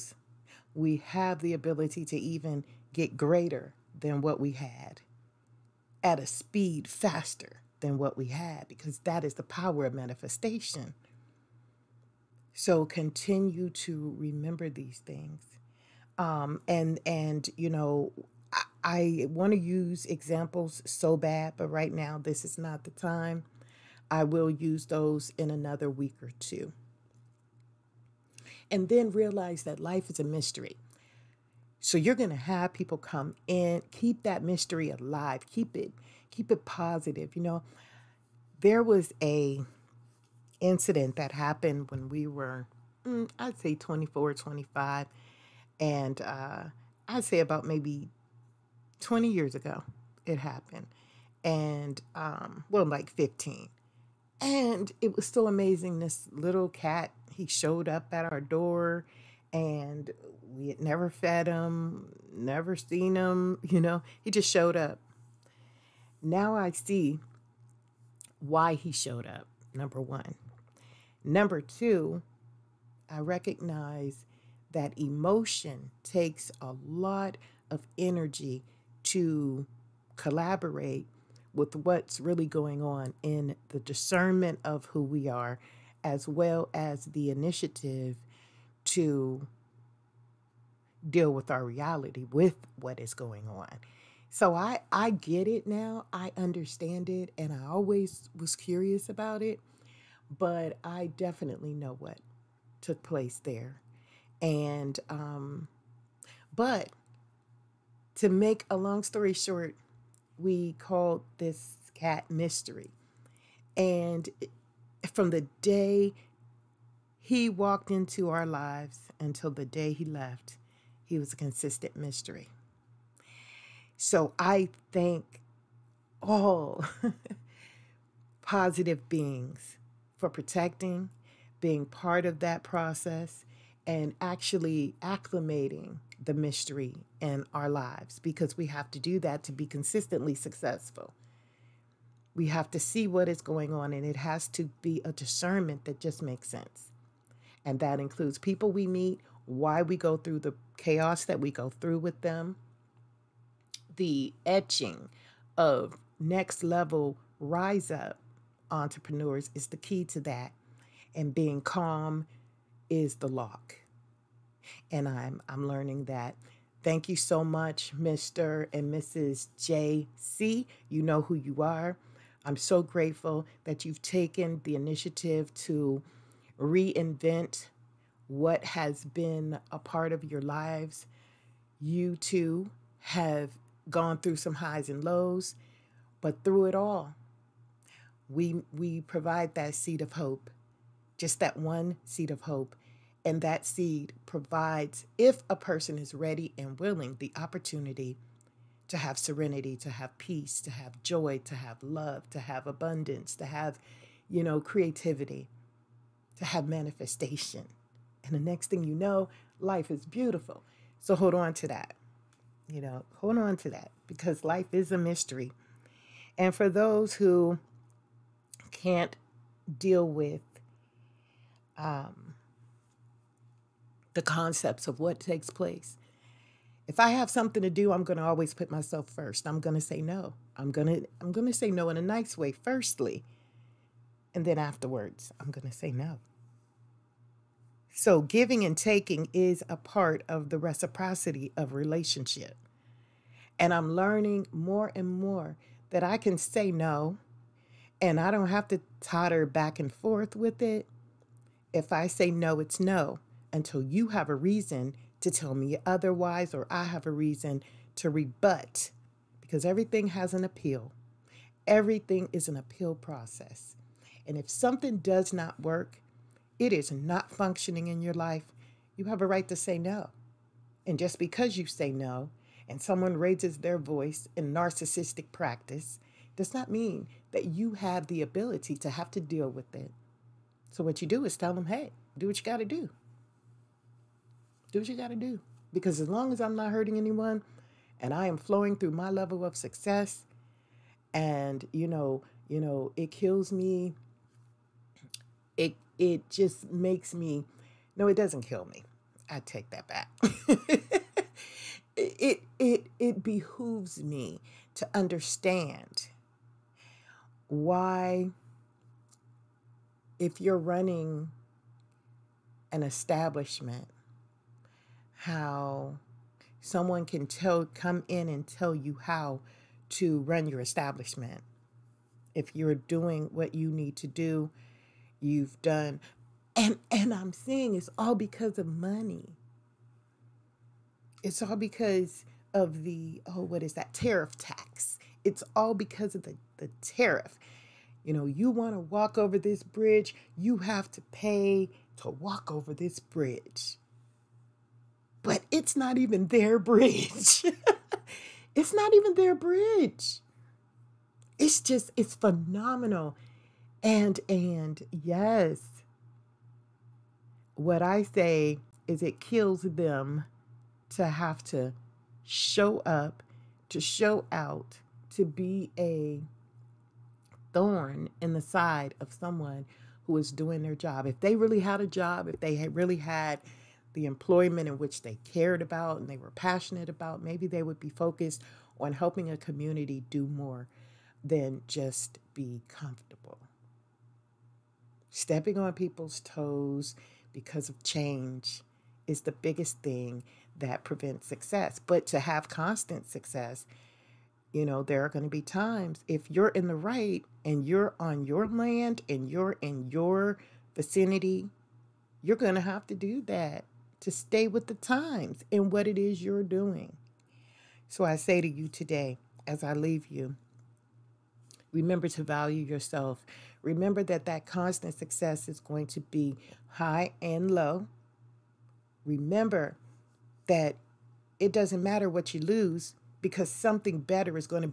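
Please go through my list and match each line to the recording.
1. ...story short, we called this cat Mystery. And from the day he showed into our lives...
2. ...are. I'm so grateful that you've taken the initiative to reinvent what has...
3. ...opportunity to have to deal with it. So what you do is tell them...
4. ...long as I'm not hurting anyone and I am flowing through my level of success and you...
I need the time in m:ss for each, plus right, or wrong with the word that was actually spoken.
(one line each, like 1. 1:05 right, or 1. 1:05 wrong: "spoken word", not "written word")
1. 1:49 wrong: "walked", not "showed"
2. 2:51 right
3. 4:38 wrong: "ability", not "opportunity"
4. 4:46 right.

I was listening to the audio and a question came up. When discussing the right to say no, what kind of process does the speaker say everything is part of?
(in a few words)
appeal process.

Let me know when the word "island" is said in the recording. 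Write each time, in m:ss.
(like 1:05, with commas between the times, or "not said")
not said.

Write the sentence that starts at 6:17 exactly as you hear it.
Maybe they would be focused on helping a community do more than just be comfortable.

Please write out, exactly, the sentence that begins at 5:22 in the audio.
If you're doing what you need to do, you've done and and I'm saying it's all because of money.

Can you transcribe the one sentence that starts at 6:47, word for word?
So I say to you today, as I leave you, remember to value yourself.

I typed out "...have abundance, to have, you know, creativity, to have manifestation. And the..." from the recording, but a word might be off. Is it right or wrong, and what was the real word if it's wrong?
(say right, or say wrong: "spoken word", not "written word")
right.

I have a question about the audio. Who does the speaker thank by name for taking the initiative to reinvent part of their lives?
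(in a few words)
Mr. and Mrs. JC.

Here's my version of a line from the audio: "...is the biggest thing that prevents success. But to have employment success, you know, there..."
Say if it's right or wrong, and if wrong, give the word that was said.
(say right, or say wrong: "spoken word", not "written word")
wrong: "constant", not "employment".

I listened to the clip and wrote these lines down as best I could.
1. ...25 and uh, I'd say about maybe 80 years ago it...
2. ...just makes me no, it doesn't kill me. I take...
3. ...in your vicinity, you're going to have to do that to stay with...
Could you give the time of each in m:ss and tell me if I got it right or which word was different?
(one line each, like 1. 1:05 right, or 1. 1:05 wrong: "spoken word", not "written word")
1. 0:44 wrong: "20", not "80"
2. 4:56 right
3. 6:39 right.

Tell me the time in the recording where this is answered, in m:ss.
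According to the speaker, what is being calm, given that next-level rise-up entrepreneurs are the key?
2:41.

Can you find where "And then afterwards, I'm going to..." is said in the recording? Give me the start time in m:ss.
3:54.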